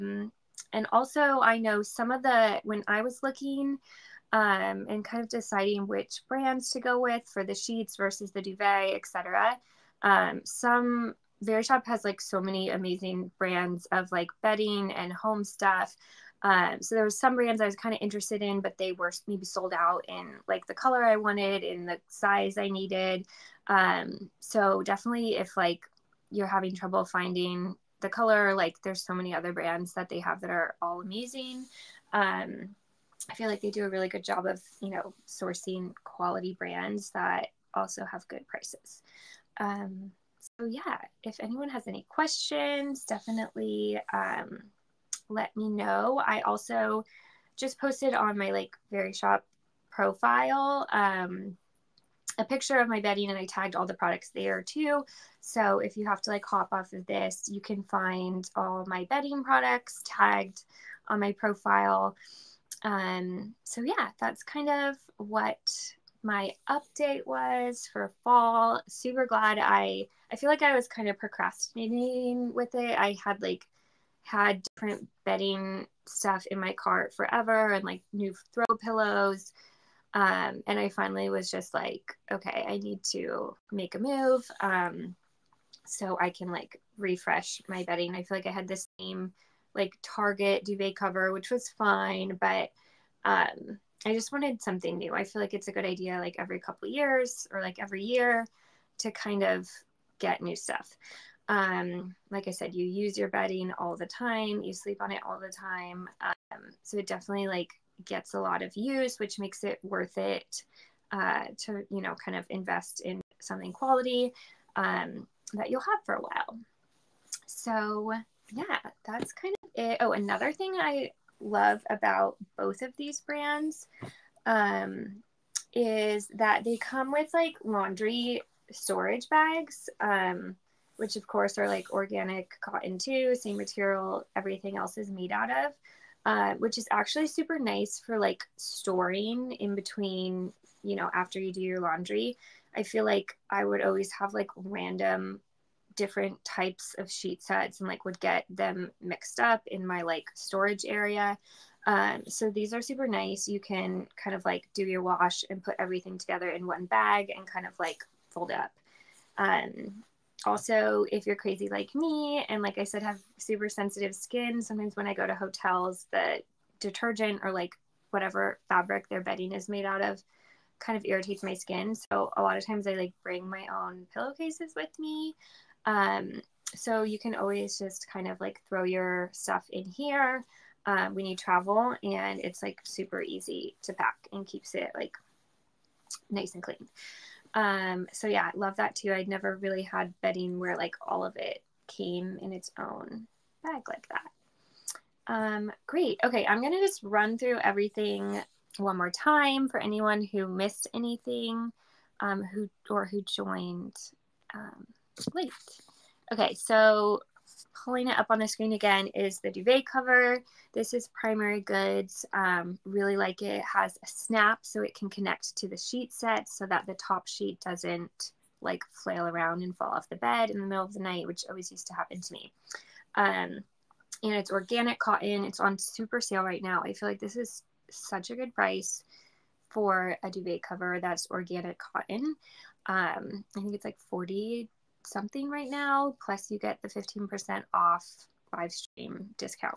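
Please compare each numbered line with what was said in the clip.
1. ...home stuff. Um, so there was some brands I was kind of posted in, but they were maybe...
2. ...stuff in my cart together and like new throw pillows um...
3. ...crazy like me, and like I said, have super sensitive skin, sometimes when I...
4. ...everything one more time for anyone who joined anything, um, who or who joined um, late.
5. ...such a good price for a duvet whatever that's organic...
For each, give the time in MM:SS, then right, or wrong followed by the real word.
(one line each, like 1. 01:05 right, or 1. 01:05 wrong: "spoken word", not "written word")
1. 00:15 wrong: "interested", not "posted"
2. 01:16 wrong: "forever", not "together"
3. 02:41 right
4. 03:17 wrong: "missed", not "joined"
5. 03:47 wrong: "cover", not "whatever".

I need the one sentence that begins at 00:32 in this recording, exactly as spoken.
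Um, I feel like they do a really good job of, you know, sourcing quality brands that also have good prices.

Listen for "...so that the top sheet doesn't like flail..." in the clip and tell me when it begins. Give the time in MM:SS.
03:36.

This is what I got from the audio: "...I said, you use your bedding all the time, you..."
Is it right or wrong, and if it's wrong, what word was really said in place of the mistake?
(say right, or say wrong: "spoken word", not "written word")
right.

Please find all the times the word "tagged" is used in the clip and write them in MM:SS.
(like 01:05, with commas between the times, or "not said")
00:53, 01:00.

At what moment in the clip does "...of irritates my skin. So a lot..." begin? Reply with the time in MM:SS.
02:50.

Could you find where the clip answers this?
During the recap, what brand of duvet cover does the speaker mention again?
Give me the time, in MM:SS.
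03:31.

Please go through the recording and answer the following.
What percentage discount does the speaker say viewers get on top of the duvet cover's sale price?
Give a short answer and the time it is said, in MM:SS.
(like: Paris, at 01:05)
15%, at 03:56.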